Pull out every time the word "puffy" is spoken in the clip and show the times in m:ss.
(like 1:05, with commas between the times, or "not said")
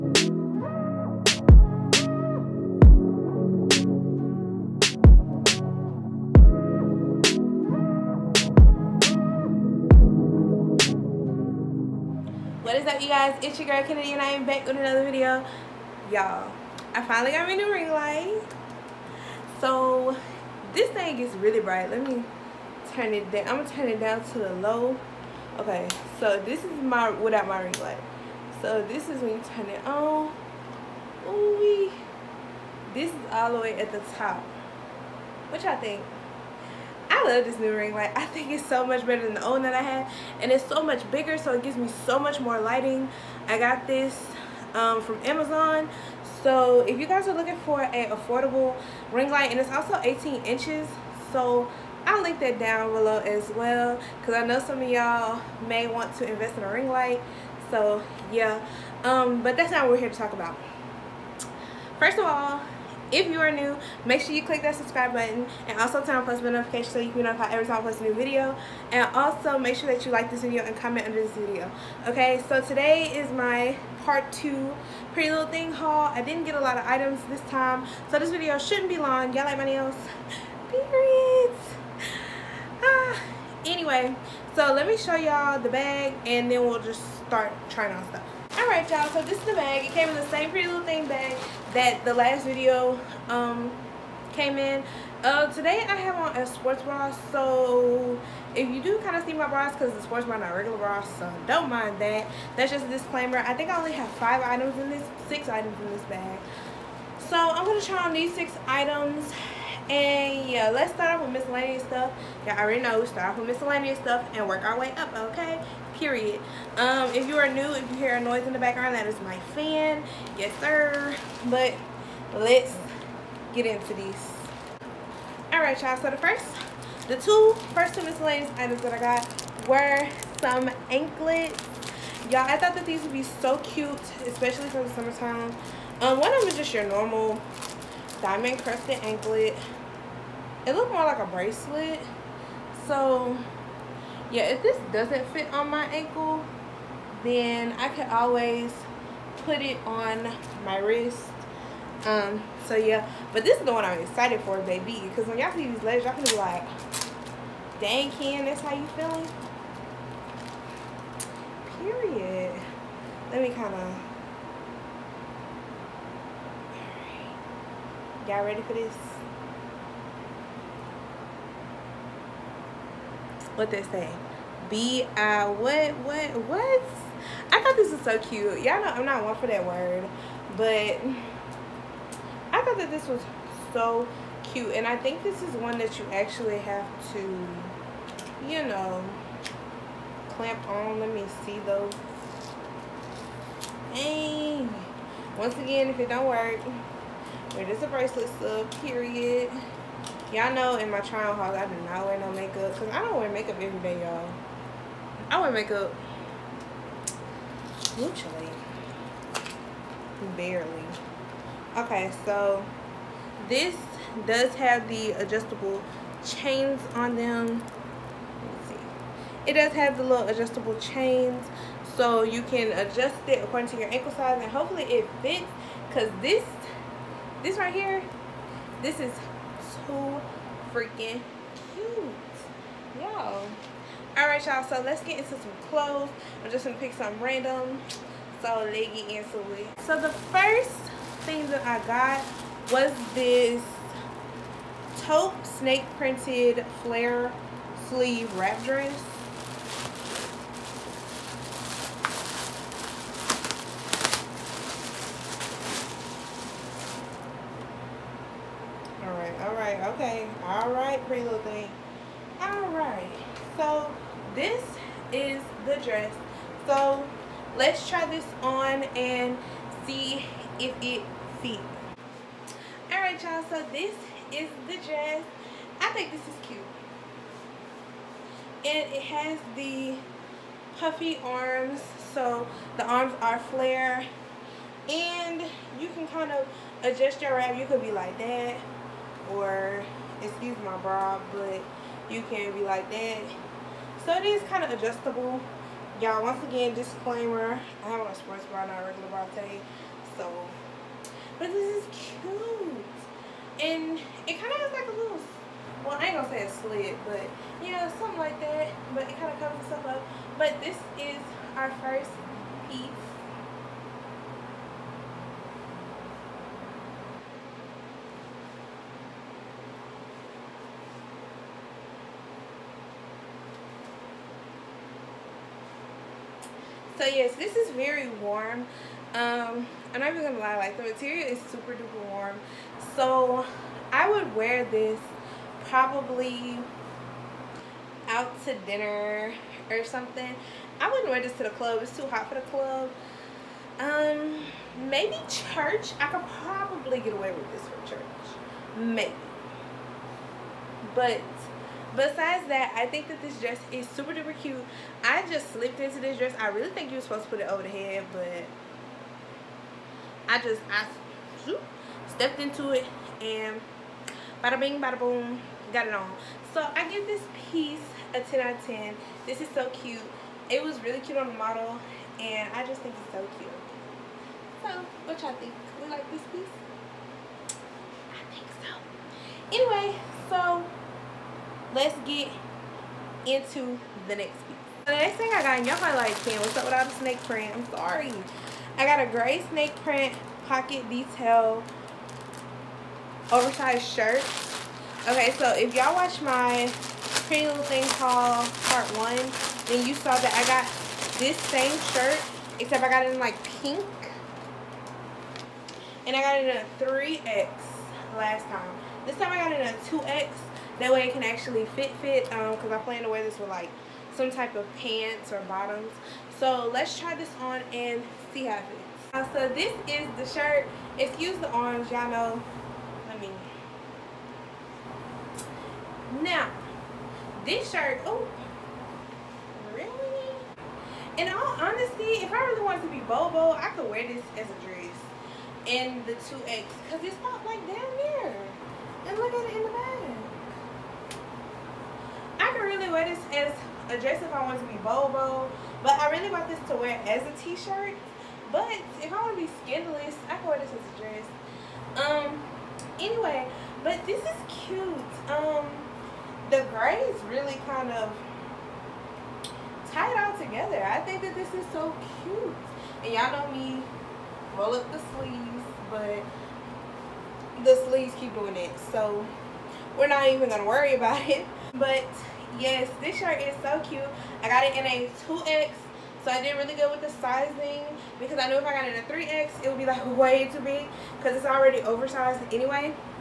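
4:40.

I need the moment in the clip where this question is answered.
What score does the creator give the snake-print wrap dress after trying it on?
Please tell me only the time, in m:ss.
6:08.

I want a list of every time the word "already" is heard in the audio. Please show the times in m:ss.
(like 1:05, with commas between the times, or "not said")
1:52, 8:01.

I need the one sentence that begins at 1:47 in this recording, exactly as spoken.
So I'm gonna try on these six items.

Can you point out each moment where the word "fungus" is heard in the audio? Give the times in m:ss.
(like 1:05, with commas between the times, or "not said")
not said.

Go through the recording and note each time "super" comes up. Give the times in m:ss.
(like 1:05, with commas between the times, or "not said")
5:31, 5:53.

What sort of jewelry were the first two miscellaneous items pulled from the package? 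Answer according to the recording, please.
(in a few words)
Anklets.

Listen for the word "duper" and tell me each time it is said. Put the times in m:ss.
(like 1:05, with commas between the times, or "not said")
5:31, 5:54.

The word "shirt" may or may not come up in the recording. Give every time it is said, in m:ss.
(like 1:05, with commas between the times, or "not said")
6:33, 6:41, 7:00, 7:07, 7:27, 7:53.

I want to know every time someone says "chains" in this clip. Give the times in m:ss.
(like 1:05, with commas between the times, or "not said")
3:36, 3:40.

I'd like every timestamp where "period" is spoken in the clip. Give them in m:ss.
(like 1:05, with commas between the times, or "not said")
1:20, 1:56, 2:41, 3:18.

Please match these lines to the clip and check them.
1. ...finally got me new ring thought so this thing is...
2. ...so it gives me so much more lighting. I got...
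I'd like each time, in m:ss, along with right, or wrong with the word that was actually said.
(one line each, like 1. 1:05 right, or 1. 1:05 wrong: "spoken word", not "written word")
1. 0:17 wrong: "light", not "thought"
2. 0:41 right.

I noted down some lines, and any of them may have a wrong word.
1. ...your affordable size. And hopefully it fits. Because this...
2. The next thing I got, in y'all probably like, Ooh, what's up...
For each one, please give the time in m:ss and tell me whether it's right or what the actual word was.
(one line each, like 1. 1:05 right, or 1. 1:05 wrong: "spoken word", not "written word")
1. 3:43 wrong: "ankle", not "affordable"
2. 6:24 wrong: "Ken", not "Ooh".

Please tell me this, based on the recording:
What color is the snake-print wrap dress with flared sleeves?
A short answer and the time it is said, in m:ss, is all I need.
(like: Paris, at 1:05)
Taupe, at 4:05.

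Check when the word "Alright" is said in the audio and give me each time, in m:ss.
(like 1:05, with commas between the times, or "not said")
1:28, 4:22, 4:32.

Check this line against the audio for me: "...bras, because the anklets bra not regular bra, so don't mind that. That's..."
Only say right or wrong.
wrong.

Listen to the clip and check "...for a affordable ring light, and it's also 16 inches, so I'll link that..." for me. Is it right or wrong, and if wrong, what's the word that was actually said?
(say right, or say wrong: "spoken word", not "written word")
wrong: "18", not "16".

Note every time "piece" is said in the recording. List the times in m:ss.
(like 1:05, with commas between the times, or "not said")
5:12, 6:07, 6:16, 6:24.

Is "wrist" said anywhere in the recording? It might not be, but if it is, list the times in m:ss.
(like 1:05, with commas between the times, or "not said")
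2:30.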